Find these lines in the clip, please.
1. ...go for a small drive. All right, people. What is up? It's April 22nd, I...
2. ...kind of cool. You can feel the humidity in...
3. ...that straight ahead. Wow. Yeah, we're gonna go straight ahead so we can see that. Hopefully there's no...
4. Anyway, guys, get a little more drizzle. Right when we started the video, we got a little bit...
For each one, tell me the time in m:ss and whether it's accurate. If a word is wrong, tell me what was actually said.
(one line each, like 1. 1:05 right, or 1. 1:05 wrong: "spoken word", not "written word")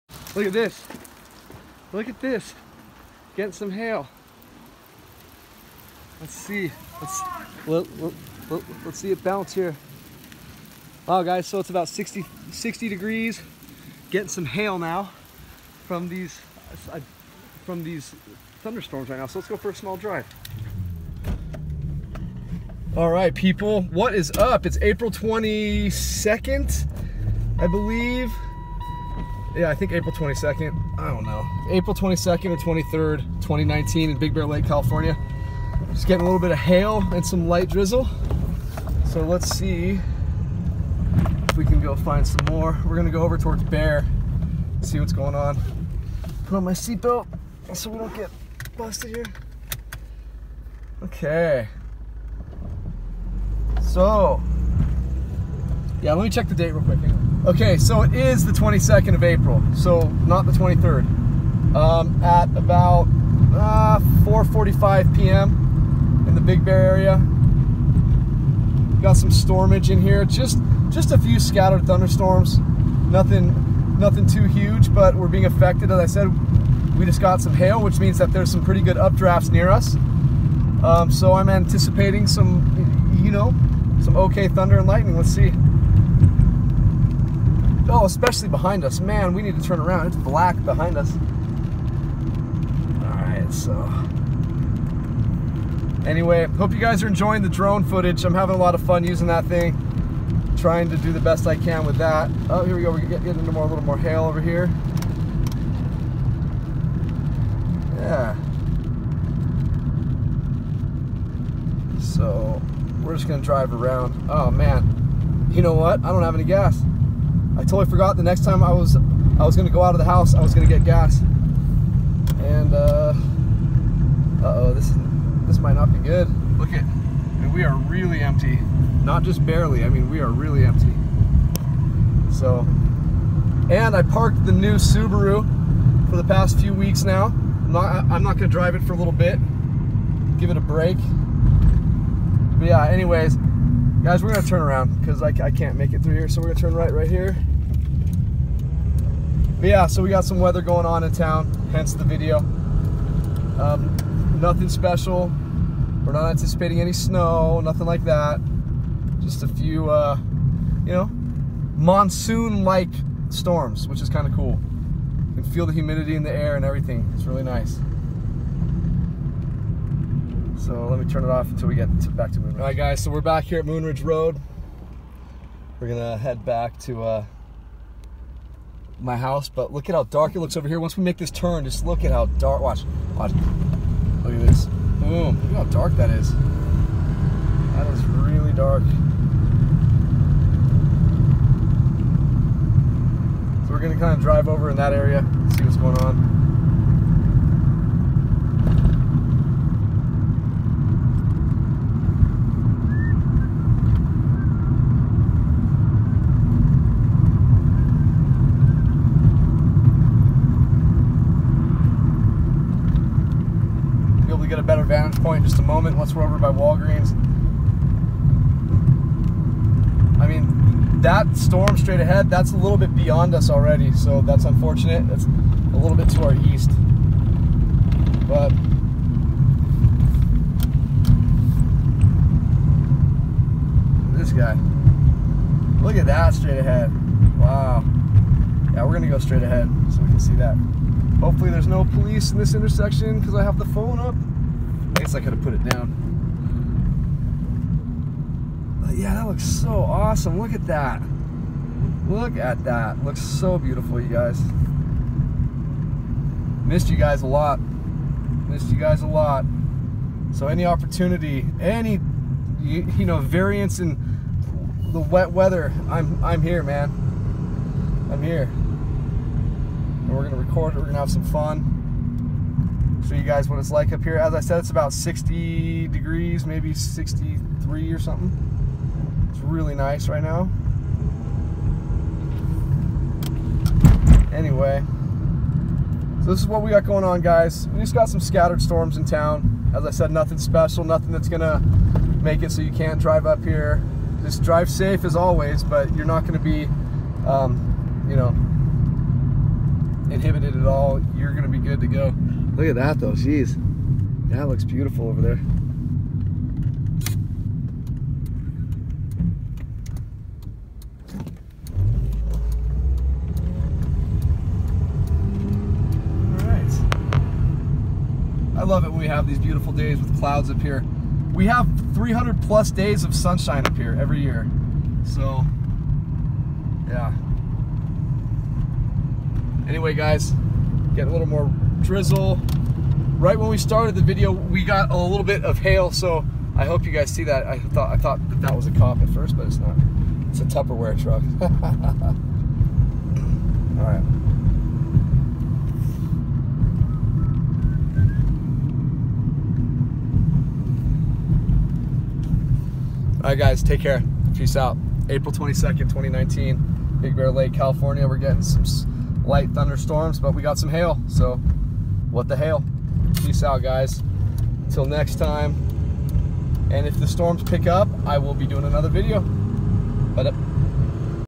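1. 0:19 right
2. 2:44 right
3. 3:56 right
4. 5:29 right.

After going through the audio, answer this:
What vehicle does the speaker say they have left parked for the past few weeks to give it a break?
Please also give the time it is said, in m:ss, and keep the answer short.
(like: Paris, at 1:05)
Subaru, at 2:14.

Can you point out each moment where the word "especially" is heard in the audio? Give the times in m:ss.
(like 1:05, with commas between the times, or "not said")
1:28.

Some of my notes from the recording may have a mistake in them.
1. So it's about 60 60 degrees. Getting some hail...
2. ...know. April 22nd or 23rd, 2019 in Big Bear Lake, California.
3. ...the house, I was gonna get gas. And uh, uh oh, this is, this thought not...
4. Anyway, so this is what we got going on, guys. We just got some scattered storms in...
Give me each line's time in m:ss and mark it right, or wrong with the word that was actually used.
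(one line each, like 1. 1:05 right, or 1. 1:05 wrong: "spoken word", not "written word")
1. 0:11 right
2. 0:31 right
3. 1:59 wrong: "might", not "thought"
4. 4:44 right.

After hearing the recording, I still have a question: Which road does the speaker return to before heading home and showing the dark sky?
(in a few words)
Moonridge Road.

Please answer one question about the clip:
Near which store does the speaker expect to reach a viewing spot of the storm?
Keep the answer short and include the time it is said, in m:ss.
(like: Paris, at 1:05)
Walgreens, at 3:36.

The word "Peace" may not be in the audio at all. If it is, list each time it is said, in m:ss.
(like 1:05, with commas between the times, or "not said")
5:54, 6:03.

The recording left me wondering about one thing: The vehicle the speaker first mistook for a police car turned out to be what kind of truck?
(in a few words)
Tupperware truck.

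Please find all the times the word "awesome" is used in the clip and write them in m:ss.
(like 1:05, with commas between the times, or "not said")
4:09.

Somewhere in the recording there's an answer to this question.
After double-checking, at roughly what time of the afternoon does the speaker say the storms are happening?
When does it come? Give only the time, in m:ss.
1:04.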